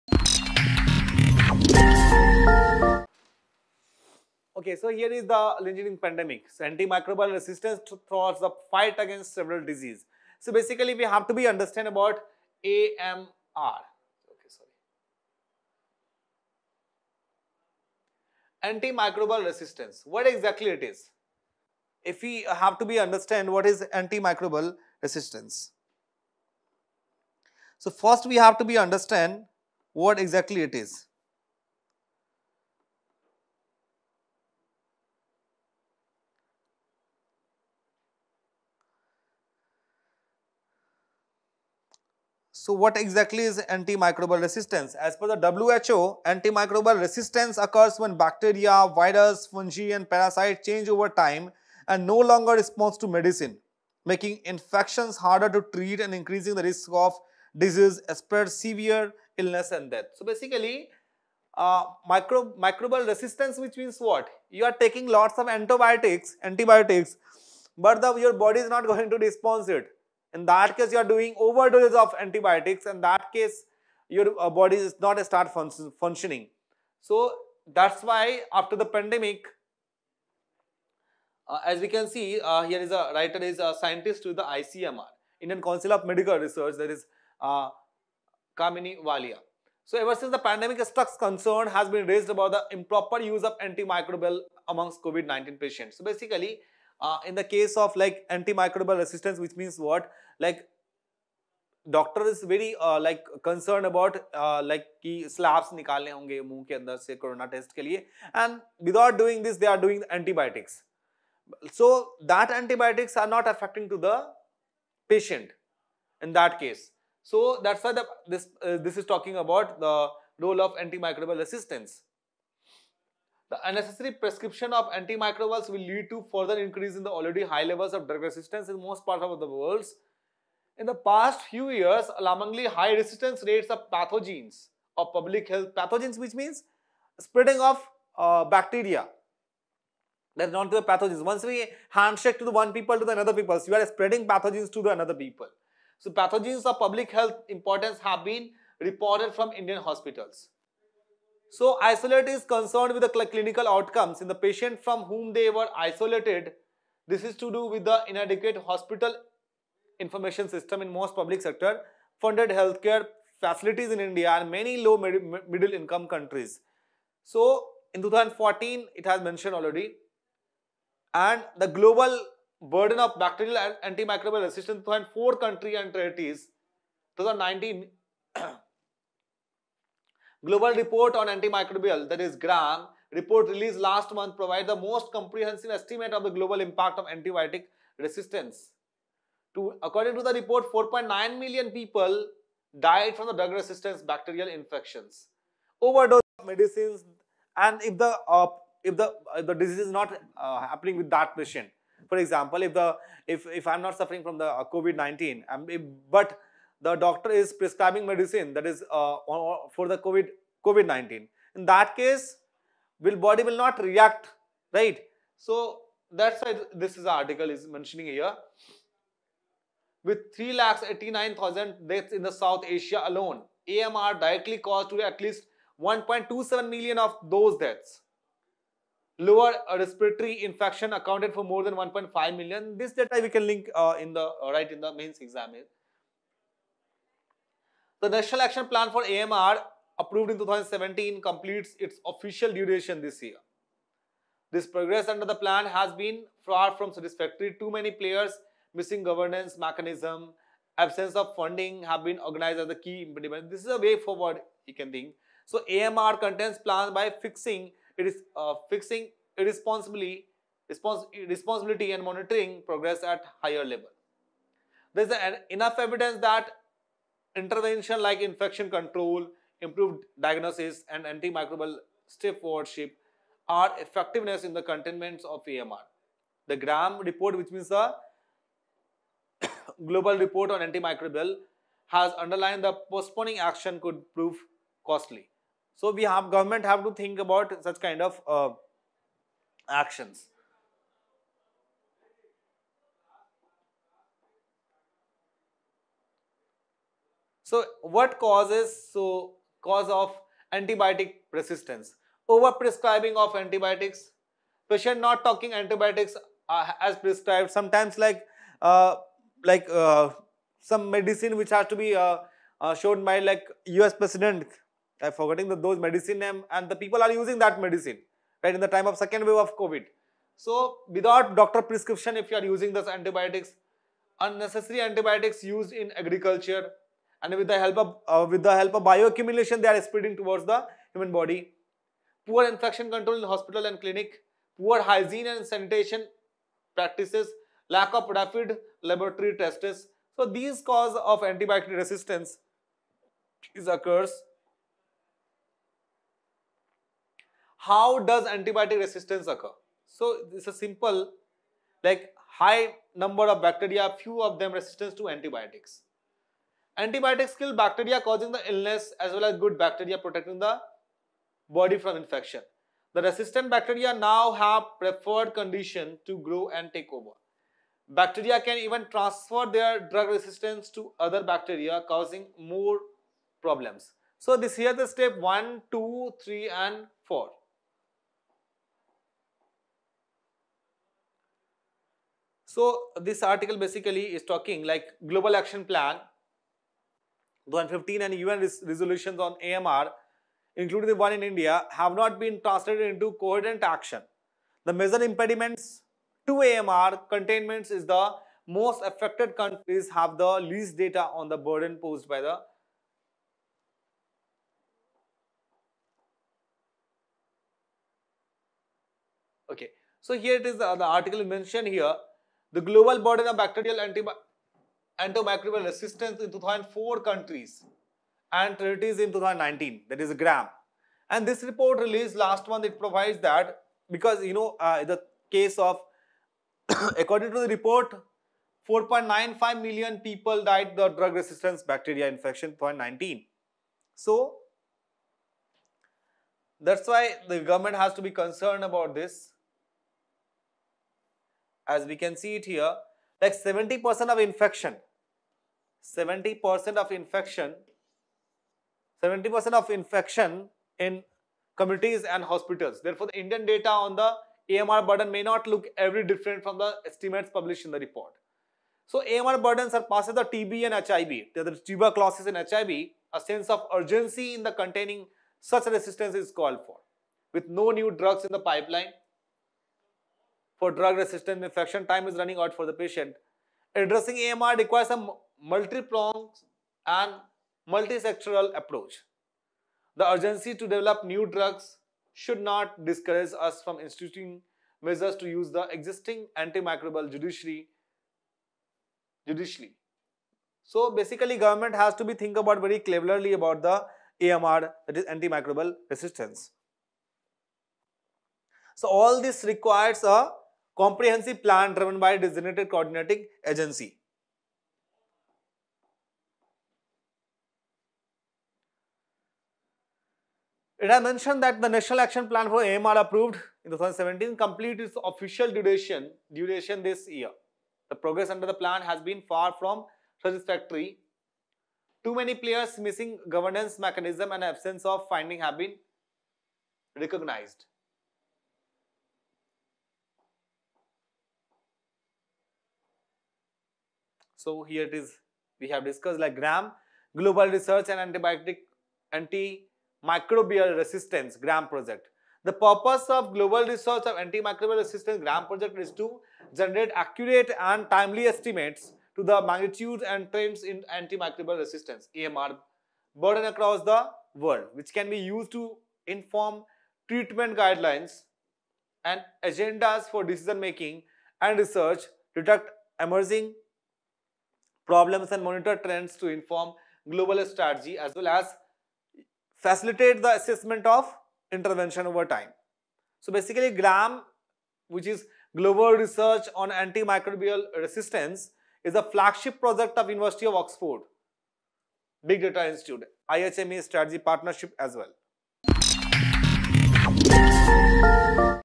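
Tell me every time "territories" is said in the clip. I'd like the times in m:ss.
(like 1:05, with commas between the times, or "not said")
2:55.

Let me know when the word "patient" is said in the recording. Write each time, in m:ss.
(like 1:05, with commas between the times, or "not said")
1:35, 1:55, 2:34, 3:21, 5:04, 7:52.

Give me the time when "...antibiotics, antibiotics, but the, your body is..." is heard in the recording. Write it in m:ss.
1:05.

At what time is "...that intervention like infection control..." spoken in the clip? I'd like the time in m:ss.
4:26.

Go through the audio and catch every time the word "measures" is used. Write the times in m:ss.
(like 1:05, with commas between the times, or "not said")
8:04.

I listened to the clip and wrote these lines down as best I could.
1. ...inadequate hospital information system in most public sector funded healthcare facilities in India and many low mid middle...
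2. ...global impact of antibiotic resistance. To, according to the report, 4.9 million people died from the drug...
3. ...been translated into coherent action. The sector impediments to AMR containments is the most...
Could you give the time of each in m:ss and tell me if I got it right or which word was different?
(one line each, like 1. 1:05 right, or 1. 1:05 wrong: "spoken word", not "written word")
1. 2:38 right
2. 3:06 right
3. 6:32 wrong: "major", not "sector".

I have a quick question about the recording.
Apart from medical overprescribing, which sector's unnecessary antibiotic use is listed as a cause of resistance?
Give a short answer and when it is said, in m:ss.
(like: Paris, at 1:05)
agriculture, at 5:25.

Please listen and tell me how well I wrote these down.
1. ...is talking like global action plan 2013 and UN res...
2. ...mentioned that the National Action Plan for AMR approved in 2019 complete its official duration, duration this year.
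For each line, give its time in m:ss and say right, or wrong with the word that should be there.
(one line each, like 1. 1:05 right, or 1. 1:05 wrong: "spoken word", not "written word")
1. 6:24 wrong: "2015", not "2013"
2. 8:30 wrong: "2017", not "2019".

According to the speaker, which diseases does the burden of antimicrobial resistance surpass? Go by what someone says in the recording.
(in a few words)
TB and HIV.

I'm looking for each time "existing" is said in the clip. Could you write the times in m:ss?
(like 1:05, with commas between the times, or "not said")
8:05.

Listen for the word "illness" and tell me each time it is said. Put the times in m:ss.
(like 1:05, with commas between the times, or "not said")
0:59, 5:58.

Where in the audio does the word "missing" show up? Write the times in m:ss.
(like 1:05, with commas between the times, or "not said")
4:08, 8:42.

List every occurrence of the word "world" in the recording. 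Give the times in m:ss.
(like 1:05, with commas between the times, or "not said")
2:09, 9:14.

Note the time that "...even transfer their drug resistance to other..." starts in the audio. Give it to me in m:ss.
6:08.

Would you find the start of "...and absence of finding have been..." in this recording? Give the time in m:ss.
8:44.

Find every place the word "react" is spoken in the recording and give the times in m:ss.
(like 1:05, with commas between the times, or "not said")
3:33.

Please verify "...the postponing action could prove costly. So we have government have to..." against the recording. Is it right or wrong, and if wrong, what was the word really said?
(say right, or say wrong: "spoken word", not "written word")
right.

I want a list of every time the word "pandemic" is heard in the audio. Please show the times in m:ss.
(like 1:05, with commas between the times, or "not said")
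1:18, 1:30.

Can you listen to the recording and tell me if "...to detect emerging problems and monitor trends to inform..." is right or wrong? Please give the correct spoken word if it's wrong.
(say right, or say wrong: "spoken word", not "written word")
right.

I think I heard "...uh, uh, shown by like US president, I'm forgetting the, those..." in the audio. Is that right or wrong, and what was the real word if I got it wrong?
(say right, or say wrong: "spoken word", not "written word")
right.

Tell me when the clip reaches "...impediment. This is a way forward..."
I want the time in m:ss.
4:13.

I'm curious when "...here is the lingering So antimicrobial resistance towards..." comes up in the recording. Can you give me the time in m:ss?
0:04.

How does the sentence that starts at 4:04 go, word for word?
This progress under the plan has been far from satisfactory.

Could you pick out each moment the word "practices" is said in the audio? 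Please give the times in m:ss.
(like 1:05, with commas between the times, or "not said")
5:36.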